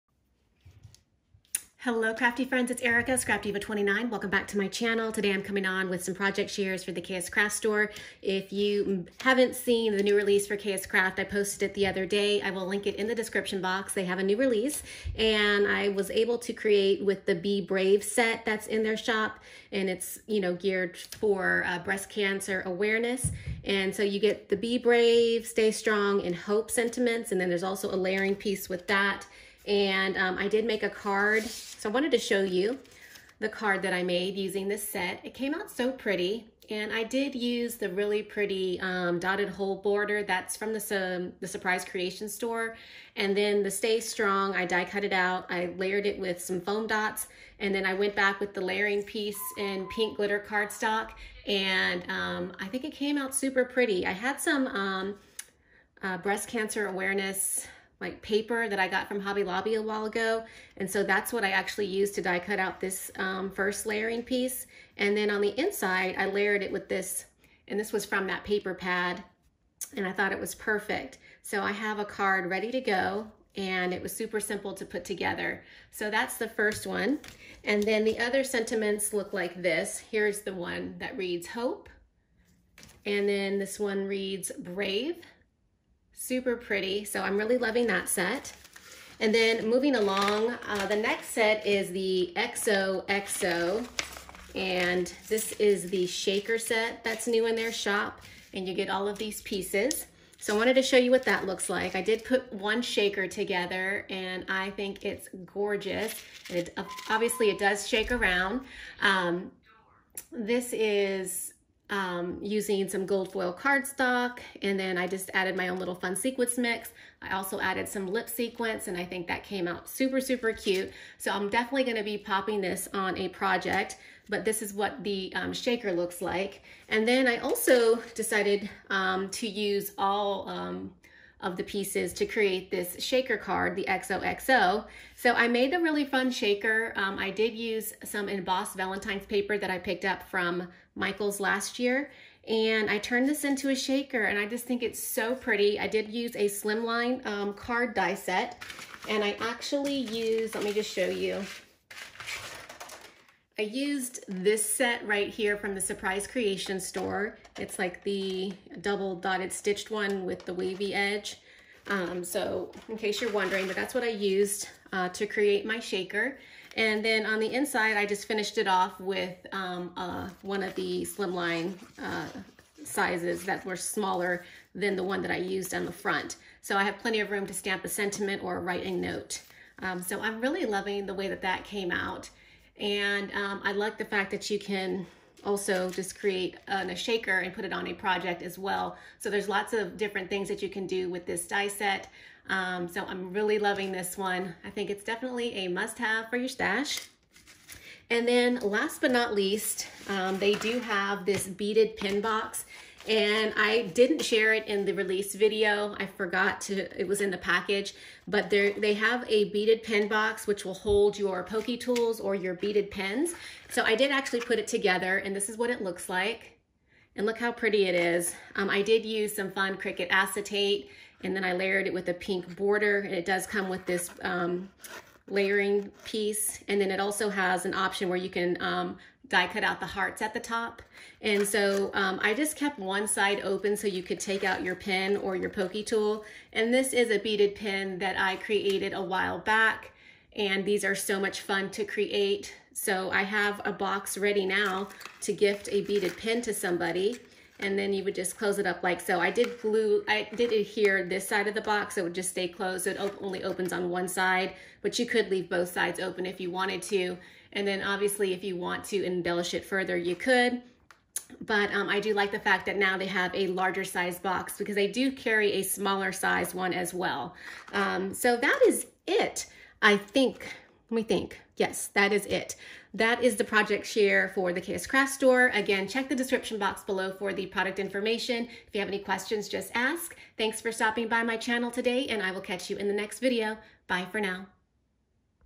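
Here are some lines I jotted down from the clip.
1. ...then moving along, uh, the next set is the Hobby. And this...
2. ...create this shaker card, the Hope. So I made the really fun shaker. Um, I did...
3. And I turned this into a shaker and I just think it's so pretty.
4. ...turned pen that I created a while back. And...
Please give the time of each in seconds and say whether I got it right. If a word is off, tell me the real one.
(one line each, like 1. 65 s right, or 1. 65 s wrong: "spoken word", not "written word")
1. 89 s wrong: "XOXO", not "Hobby"
2. 132 s wrong: "XOXO", not "Hope"
3. 142 s right
4. 237 s wrong: "beaded", not "turned".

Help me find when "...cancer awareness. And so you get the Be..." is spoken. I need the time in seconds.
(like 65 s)
22 s.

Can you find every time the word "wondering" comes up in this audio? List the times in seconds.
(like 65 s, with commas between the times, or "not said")
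163 s.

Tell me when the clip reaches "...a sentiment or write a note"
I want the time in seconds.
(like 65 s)
177 s.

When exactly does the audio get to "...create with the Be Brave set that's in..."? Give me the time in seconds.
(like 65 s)
16 s.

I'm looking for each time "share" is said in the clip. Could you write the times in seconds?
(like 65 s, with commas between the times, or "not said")
6 s, 204 s, 273 s.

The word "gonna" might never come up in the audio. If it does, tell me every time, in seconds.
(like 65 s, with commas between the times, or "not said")
121 s.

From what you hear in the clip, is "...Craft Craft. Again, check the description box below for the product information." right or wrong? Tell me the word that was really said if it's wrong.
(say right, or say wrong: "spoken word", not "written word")
wrong: "Store", not "Craft".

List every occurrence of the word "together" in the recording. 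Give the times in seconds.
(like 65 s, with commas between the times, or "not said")
75 s, 103 s, 214 s.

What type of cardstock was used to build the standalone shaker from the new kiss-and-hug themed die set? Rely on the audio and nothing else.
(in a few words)
gold foil.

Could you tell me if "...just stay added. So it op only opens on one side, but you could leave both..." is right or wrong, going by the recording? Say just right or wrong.
wrong.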